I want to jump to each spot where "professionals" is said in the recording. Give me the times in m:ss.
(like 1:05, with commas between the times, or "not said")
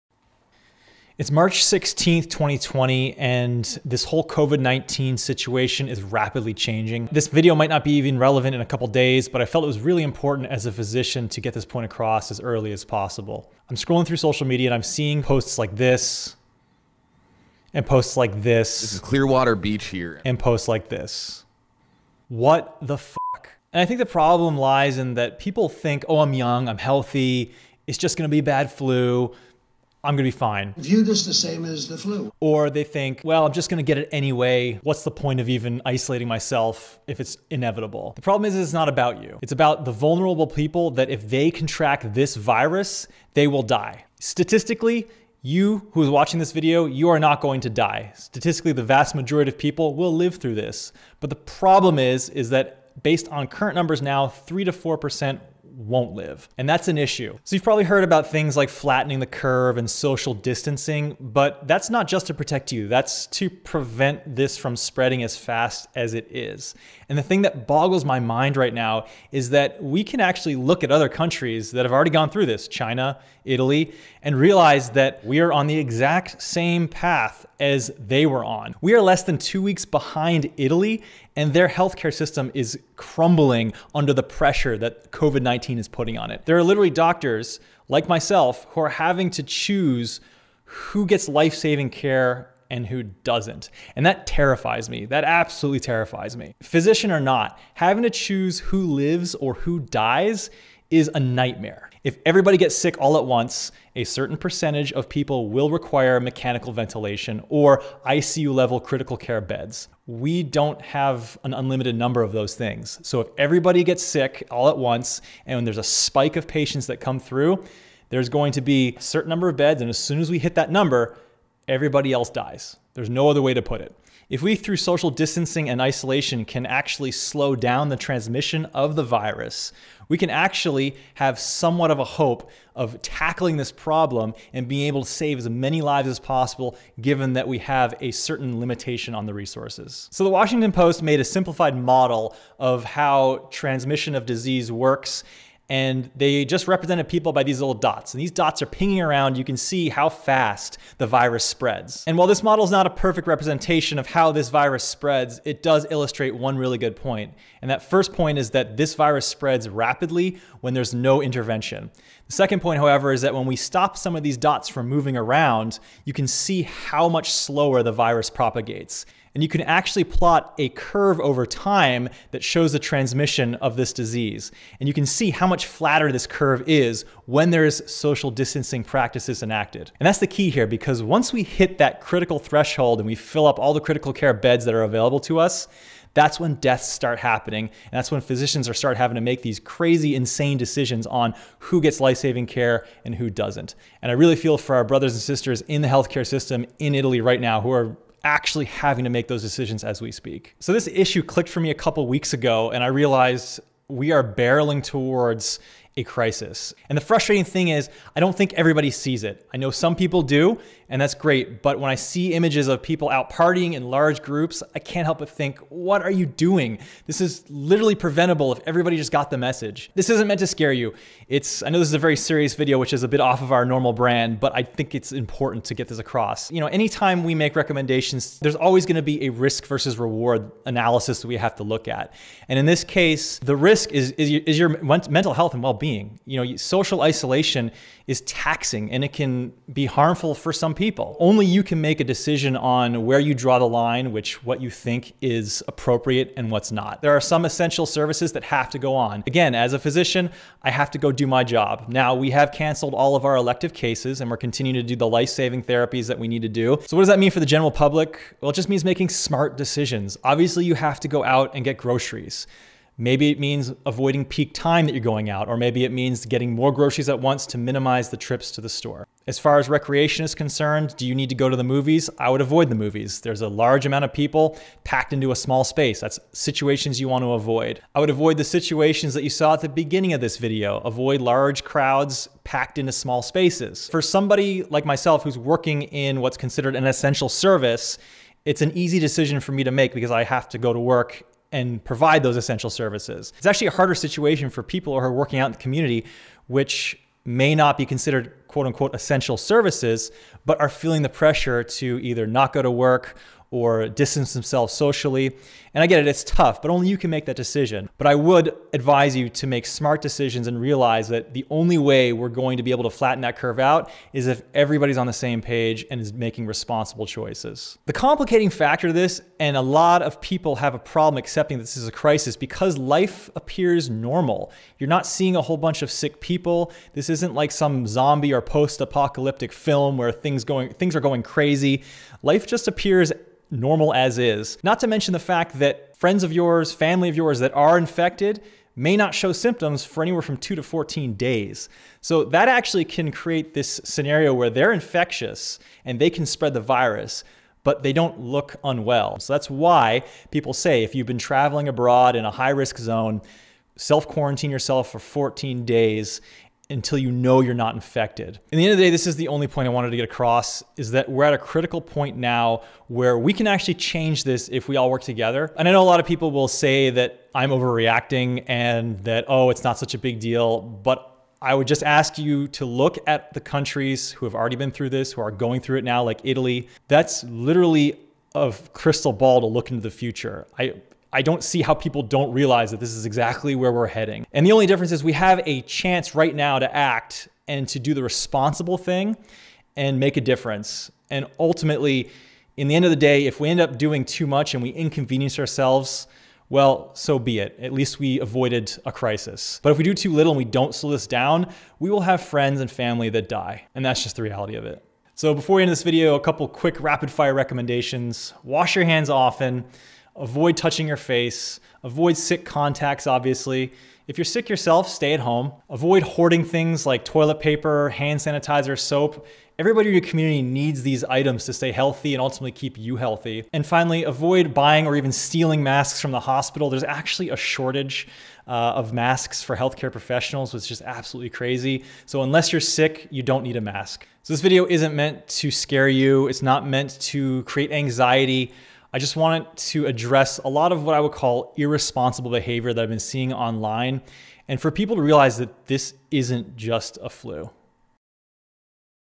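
7:09.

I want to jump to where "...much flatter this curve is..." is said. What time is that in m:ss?
2:55.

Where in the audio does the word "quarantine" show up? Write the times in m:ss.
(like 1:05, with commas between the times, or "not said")
5:54.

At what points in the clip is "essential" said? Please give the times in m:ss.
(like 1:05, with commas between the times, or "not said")
4:07, 4:46, 4:52, 4:58.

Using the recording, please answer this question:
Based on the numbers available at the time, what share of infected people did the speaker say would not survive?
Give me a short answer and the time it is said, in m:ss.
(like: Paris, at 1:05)
3 to 4%, at 0:54.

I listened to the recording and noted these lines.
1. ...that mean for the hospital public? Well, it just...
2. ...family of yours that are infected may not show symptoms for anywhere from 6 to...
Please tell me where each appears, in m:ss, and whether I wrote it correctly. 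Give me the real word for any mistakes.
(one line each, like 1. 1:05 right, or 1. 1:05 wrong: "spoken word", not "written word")
1. 4:17 wrong: "general", not "hospital"
2. 5:36 wrong: "2", not "6".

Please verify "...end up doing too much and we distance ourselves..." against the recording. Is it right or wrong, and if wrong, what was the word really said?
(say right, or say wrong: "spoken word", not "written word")
wrong: "inconvenience", not "distance".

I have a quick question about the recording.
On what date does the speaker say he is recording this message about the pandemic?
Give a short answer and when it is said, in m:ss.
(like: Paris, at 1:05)
March 16th, 2020, at 0:01.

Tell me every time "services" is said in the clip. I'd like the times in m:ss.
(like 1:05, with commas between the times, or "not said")
4:07, 4:47, 4:52, 4:59.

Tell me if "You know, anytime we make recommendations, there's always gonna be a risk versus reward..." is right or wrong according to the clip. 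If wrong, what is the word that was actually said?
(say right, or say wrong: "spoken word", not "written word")
right.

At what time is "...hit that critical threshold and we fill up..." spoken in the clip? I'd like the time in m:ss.
3:01.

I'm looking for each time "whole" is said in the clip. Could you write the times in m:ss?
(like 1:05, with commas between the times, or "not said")
0:04, 5:25.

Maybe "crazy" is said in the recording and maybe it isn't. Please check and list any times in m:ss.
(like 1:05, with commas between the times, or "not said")
3:09, 5:31, 7:11.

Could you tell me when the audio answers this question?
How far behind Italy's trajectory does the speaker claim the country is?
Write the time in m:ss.
1:19.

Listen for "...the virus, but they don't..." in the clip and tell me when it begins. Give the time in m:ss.
5:46.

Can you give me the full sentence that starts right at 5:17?
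The complicating factor to this, and a lot of people have a problem accepting this is a crisis because life appears normal.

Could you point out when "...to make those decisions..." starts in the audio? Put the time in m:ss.
3:19.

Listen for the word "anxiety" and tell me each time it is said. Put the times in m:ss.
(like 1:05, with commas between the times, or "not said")
7:17.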